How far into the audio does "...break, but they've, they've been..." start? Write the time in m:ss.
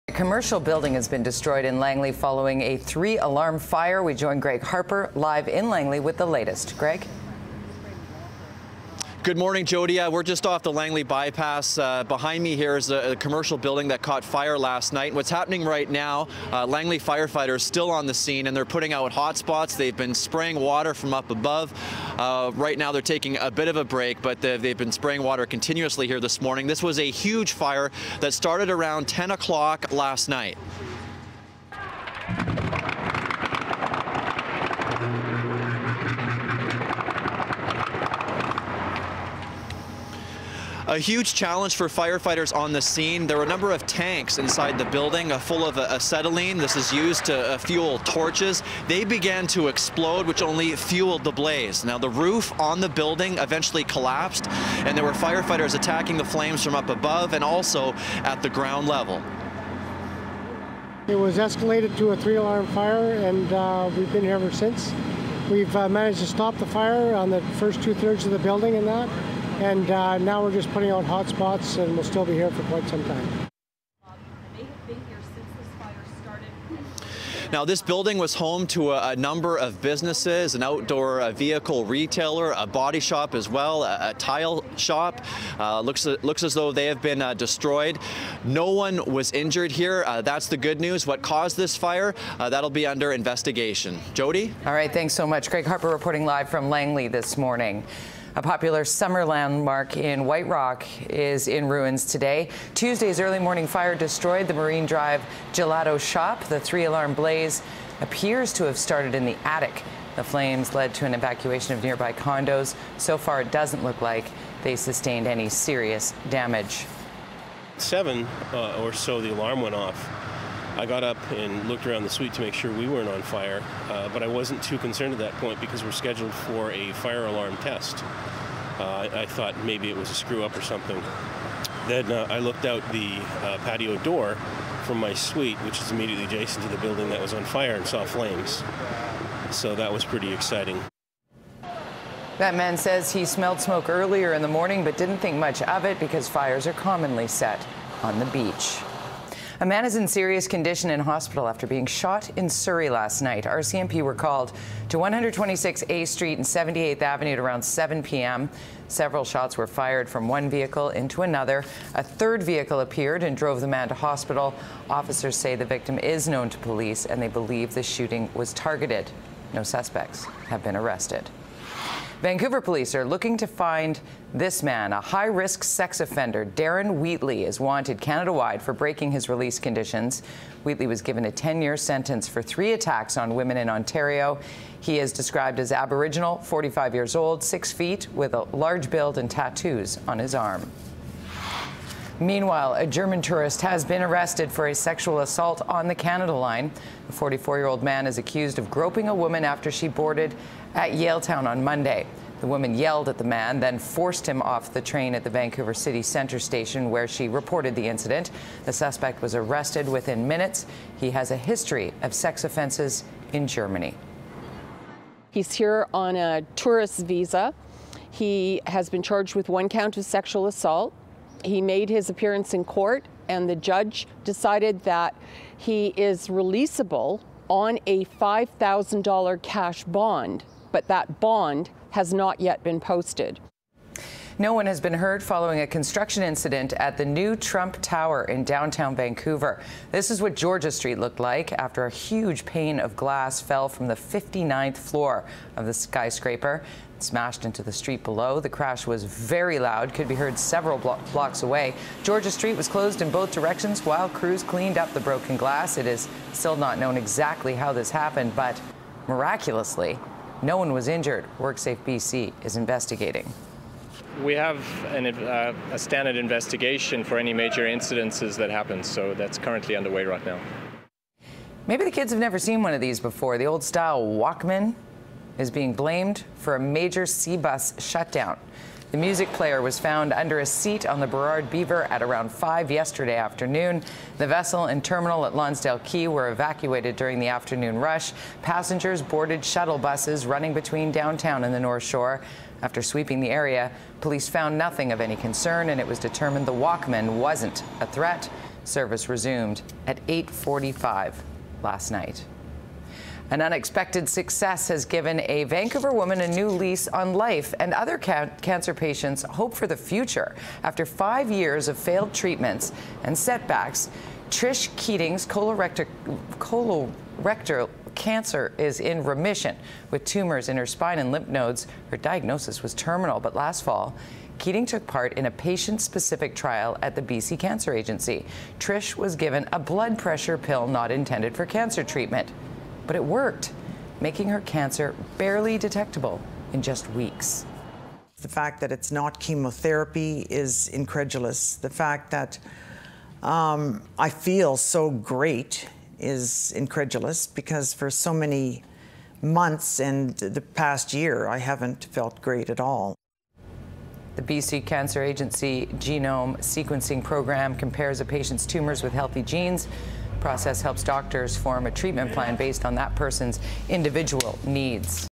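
0:23.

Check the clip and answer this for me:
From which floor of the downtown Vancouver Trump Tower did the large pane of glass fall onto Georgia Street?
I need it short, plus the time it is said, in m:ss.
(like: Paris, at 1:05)
59th floor, at 4:03.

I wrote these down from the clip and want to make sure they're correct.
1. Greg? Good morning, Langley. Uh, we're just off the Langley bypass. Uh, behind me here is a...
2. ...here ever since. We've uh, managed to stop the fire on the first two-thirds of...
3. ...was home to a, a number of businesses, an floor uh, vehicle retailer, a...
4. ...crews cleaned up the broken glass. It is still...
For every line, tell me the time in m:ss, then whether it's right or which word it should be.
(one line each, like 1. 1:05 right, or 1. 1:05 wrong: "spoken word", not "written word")
1. 0:06 wrong: "Jody", not "Langley"
2. 1:04 right
3. 1:18 wrong: "outdoor", not "floor"
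4. 4:14 right.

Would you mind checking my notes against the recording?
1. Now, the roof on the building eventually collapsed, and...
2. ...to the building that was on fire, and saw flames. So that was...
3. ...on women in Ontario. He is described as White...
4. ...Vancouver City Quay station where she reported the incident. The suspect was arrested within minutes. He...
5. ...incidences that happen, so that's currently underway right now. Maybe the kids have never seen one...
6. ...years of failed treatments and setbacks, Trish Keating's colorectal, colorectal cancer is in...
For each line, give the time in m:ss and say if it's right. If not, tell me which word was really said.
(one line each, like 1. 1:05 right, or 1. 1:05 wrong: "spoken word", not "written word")
1. 0:51 right
2. 2:16 right
3. 3:03 wrong: "Aboriginal", not "White"
4. 3:25 wrong: "Centre", not "Quay"
5. 4:27 right
6. 5:11 right.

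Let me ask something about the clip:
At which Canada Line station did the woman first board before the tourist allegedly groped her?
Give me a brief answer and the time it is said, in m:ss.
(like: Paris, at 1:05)
Yaletown, at 3:20.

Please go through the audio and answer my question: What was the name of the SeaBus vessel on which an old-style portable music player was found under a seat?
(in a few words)
Burrard Beaver.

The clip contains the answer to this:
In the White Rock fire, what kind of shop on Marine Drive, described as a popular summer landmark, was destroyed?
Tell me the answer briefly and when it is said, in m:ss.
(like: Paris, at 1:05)
gelato shop, at 1:45.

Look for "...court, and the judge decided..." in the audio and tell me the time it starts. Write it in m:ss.
3:42.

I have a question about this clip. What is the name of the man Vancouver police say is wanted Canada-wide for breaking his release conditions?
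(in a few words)
Darren Wheatley.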